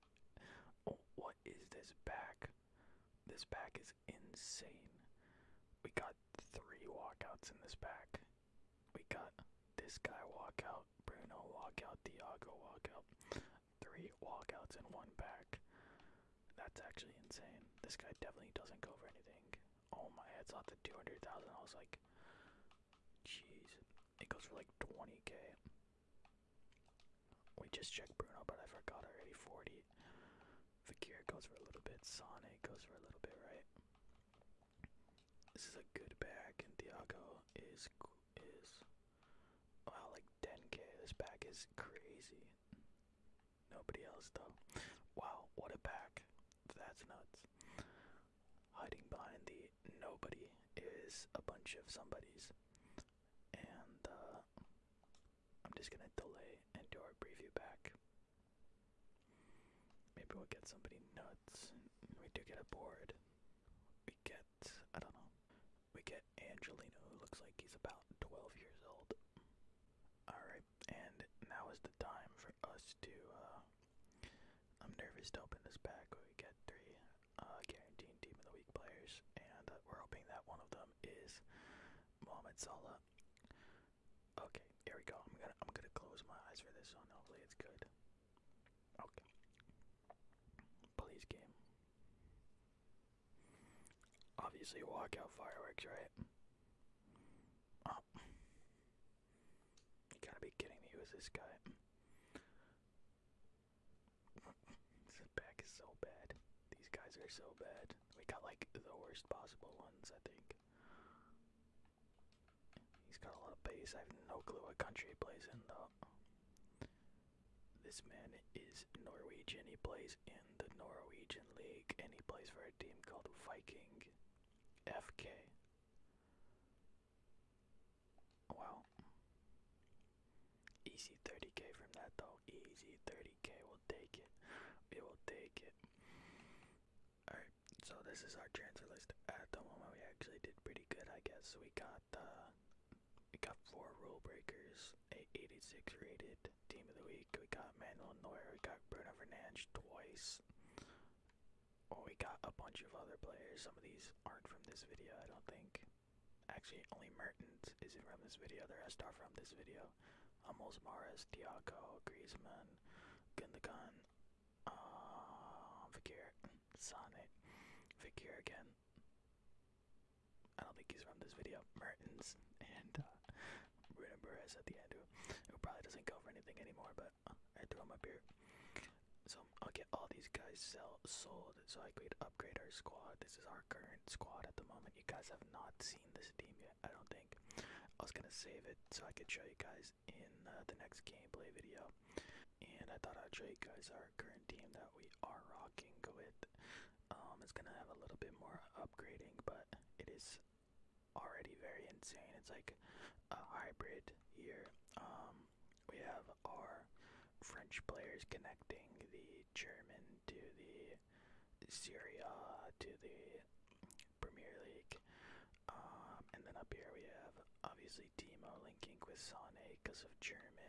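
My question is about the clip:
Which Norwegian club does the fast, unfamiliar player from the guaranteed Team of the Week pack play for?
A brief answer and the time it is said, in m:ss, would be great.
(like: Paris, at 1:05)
Viking FK, at 2:03.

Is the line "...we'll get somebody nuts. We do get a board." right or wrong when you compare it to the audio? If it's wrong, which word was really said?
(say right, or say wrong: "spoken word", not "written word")
right.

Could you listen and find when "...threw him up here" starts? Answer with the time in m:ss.
2:57.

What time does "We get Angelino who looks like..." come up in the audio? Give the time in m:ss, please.
1:05.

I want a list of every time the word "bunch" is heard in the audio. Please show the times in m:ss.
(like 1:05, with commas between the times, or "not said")
0:51, 2:32.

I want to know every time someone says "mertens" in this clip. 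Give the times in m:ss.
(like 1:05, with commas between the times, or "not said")
2:37, 2:51.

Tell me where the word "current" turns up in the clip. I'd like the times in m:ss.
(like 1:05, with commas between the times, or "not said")
3:03, 3:14.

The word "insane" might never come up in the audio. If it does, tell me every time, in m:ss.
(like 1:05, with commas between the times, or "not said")
0:17, 3:21.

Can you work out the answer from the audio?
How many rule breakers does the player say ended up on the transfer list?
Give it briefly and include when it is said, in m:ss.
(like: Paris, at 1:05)
4, at 2:23.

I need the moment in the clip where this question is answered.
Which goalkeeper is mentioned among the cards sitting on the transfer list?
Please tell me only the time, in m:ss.
2:27.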